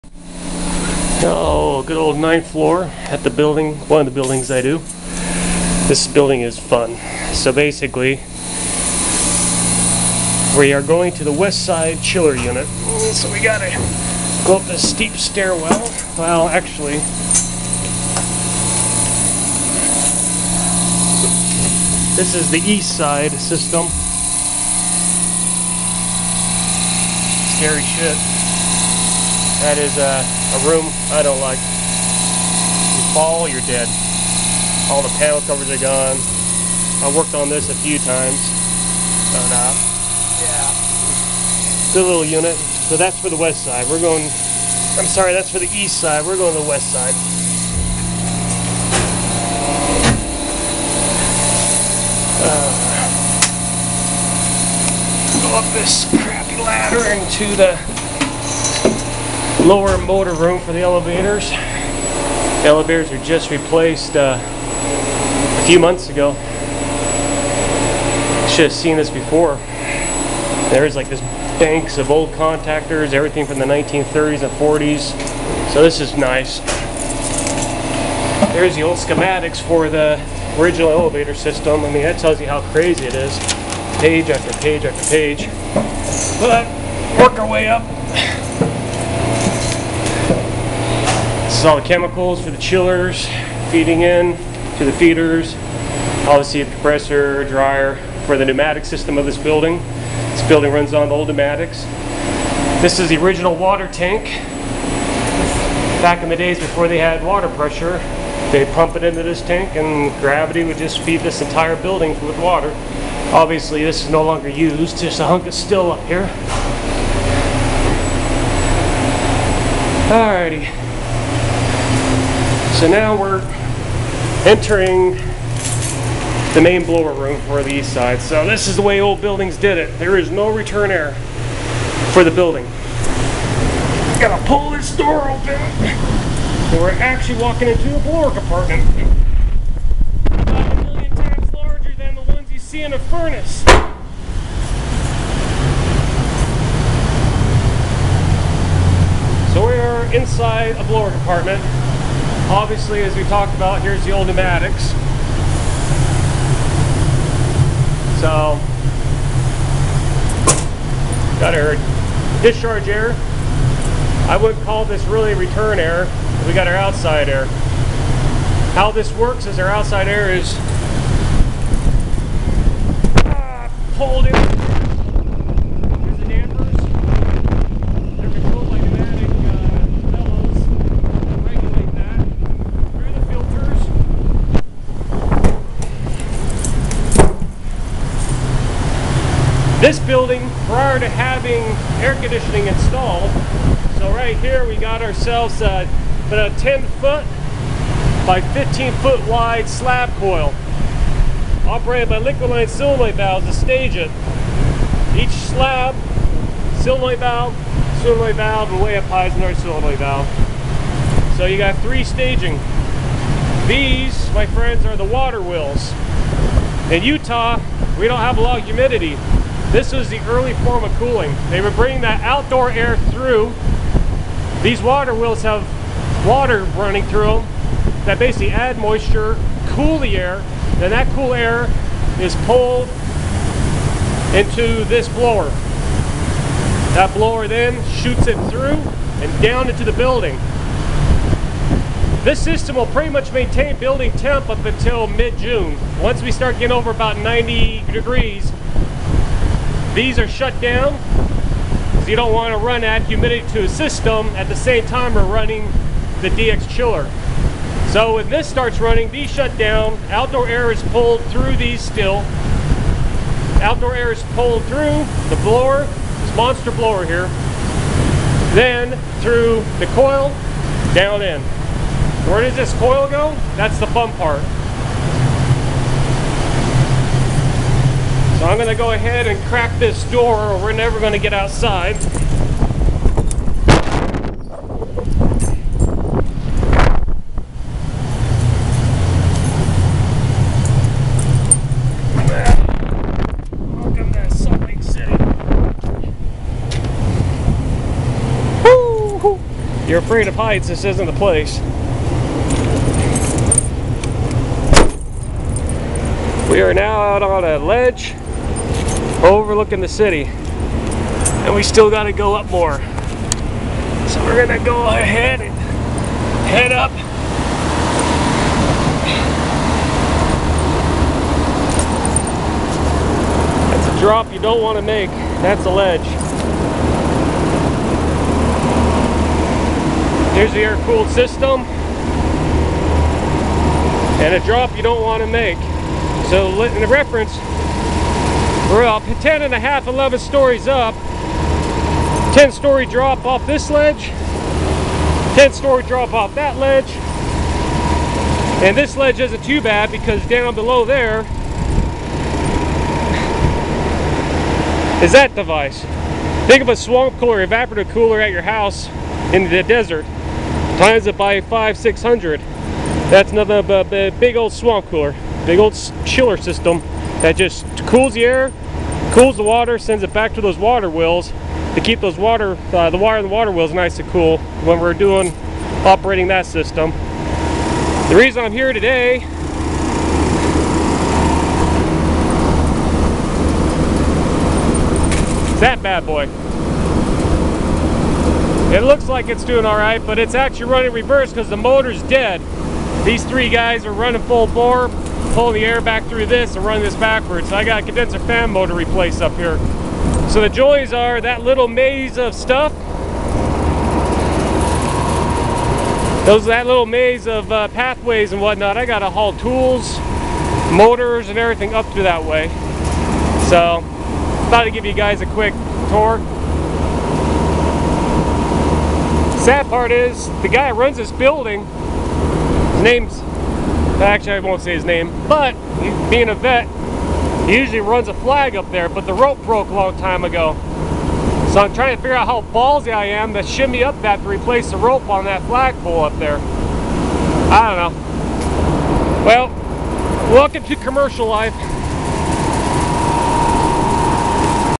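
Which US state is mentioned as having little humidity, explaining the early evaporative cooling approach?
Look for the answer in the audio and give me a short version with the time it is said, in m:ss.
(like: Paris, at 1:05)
Utah, at 3:37.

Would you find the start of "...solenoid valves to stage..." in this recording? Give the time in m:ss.
3:22.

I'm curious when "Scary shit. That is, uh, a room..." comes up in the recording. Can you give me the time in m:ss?
0:27.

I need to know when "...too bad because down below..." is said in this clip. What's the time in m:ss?
5:49.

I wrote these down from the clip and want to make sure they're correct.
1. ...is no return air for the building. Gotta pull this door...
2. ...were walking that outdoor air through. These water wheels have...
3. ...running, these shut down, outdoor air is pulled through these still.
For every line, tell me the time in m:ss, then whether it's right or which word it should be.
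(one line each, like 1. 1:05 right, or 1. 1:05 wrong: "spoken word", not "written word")
1. 2:10 right
2. 3:41 wrong: "bringing", not "walking"
3. 4:18 right.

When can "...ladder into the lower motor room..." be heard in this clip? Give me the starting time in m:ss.
0:56.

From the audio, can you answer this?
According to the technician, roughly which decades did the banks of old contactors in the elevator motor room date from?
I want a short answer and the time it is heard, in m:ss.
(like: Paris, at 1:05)
1930s and 40s, at 1:13.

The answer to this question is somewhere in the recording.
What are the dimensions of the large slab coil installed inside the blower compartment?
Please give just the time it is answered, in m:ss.
3:16.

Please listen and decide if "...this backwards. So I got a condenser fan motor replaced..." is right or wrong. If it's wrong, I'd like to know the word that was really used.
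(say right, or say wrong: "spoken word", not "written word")
right.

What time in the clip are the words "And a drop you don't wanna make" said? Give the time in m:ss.
5:34.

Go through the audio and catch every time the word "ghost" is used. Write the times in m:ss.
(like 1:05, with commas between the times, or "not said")
not said.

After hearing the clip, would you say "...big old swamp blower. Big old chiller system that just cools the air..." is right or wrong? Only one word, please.
wrong.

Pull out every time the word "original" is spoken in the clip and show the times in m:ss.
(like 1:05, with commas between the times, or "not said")
1:20, 1:43.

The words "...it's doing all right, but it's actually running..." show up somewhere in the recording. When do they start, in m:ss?
6:29.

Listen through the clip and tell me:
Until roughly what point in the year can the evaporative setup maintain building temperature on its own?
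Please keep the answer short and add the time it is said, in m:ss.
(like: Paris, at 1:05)
mid-June, at 4:05.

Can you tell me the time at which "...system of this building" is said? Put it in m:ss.
1:38.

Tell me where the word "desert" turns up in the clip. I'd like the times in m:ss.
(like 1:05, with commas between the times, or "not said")
5:59.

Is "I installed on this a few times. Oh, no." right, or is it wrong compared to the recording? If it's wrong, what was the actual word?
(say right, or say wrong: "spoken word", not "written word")
wrong: "worked", not "installed".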